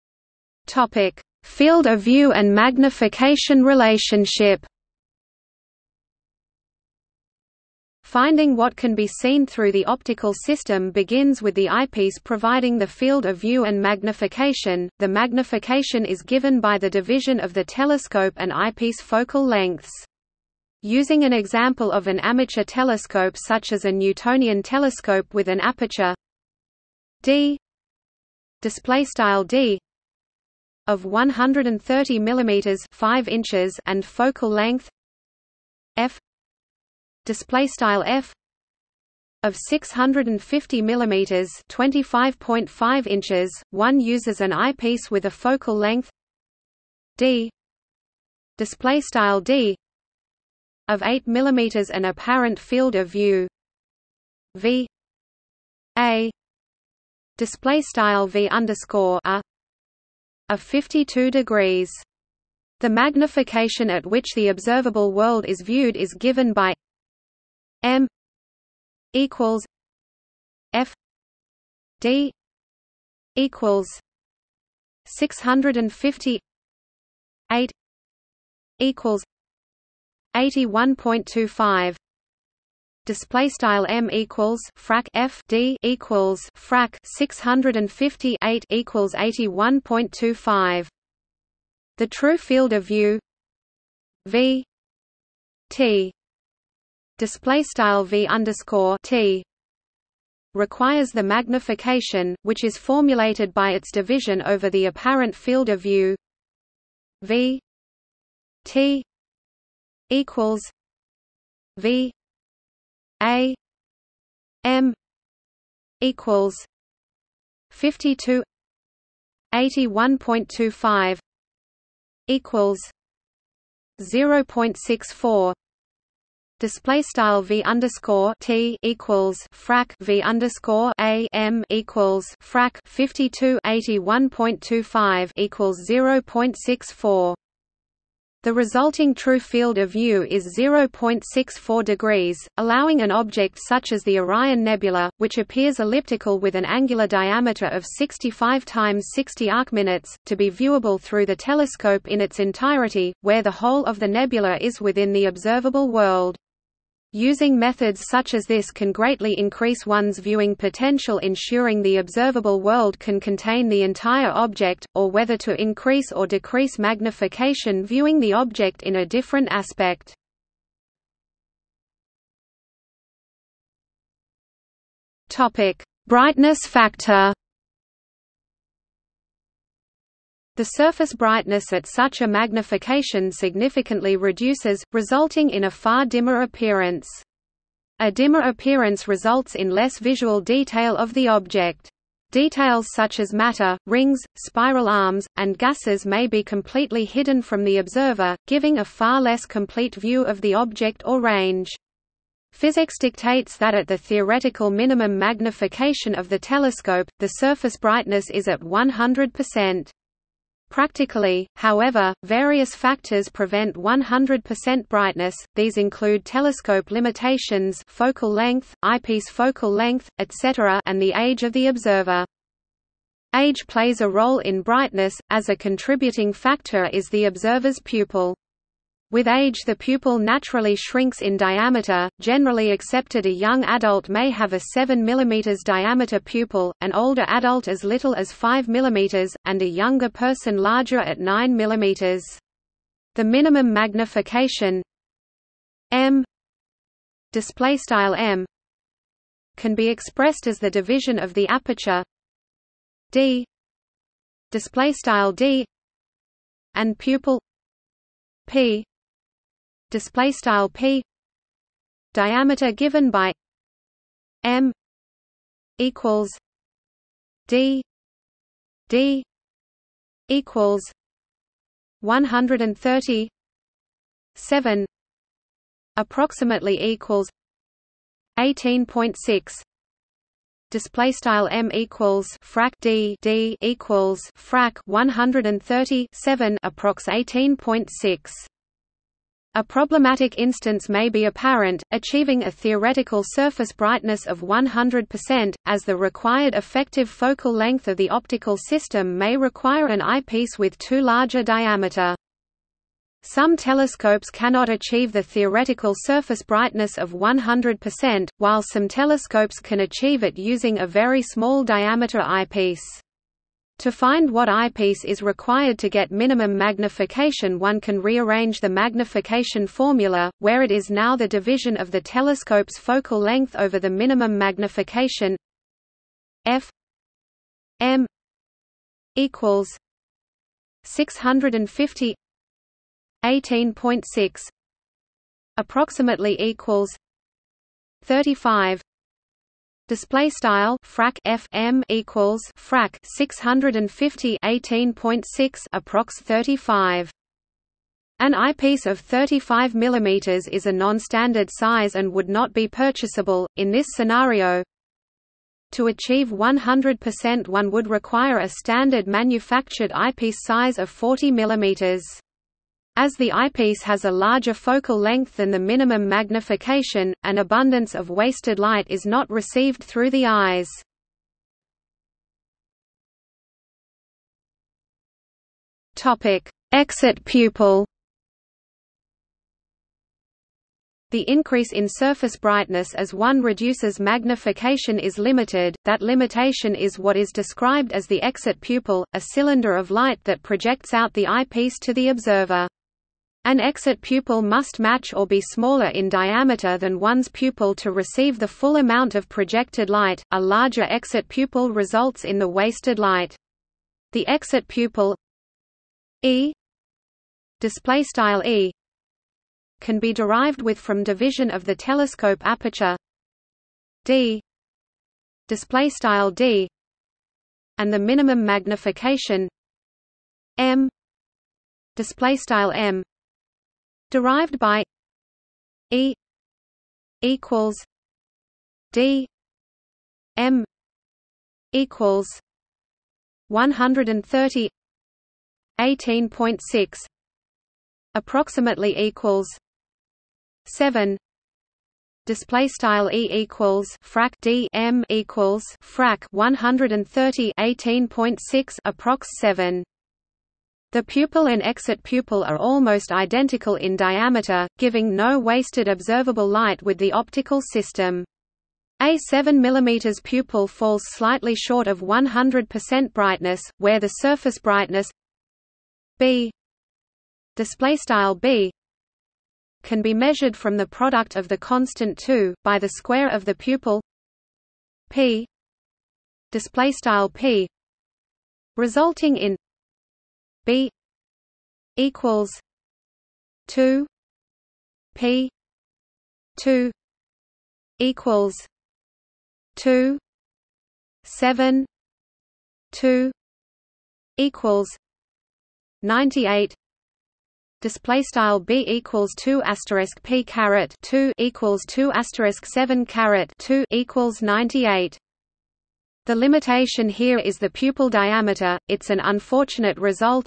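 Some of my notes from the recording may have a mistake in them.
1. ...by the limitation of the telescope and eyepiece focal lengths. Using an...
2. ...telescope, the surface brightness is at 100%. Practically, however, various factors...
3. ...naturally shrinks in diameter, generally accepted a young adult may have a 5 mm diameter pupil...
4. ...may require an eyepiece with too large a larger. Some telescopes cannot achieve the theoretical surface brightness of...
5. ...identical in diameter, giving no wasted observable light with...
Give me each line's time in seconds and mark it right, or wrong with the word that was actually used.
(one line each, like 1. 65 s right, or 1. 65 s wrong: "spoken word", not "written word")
1. 16 s wrong: "division", not "limitation"
2. 206 s right
3. 230 s wrong: "7", not "5"
4. 299 s wrong: "diameter", not "larger"
5. 453 s right.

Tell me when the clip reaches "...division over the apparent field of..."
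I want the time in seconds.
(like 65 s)
103 s.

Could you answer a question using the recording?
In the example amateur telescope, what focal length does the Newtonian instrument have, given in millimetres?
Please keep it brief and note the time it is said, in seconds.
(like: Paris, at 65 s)
650 mm, at 39 s.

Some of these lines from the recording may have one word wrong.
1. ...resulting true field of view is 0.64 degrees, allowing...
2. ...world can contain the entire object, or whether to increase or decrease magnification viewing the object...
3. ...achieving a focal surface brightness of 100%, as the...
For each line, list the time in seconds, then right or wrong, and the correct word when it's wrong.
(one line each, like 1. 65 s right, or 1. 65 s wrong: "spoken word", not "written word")
1. 138 s right
2. 162 s right
3. 291 s wrong: "theoretical", not "focal".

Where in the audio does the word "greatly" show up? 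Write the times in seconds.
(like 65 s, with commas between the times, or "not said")
158 s.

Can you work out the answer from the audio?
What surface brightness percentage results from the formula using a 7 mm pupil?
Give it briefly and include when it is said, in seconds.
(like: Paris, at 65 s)
98, at 496 s.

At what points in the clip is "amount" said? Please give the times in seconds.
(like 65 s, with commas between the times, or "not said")
398 s.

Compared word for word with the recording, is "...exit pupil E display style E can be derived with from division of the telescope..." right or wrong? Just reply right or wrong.
right.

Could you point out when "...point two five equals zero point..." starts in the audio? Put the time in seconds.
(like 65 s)
120 s.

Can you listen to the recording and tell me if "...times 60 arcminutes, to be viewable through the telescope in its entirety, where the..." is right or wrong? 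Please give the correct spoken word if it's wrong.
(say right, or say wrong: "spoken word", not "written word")
right.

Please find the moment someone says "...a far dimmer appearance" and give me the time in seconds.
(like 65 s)
185 s.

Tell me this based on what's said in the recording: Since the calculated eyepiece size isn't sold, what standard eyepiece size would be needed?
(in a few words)
40 mm.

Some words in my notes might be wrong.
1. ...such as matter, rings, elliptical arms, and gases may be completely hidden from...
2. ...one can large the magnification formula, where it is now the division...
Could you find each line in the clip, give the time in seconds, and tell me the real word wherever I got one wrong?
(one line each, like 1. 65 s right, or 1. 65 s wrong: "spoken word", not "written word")
1. 192 s wrong: "spiral", not "elliptical"
2. 317 s wrong: "rearrange", not "large".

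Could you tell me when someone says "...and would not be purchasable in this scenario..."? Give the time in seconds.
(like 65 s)
351 s.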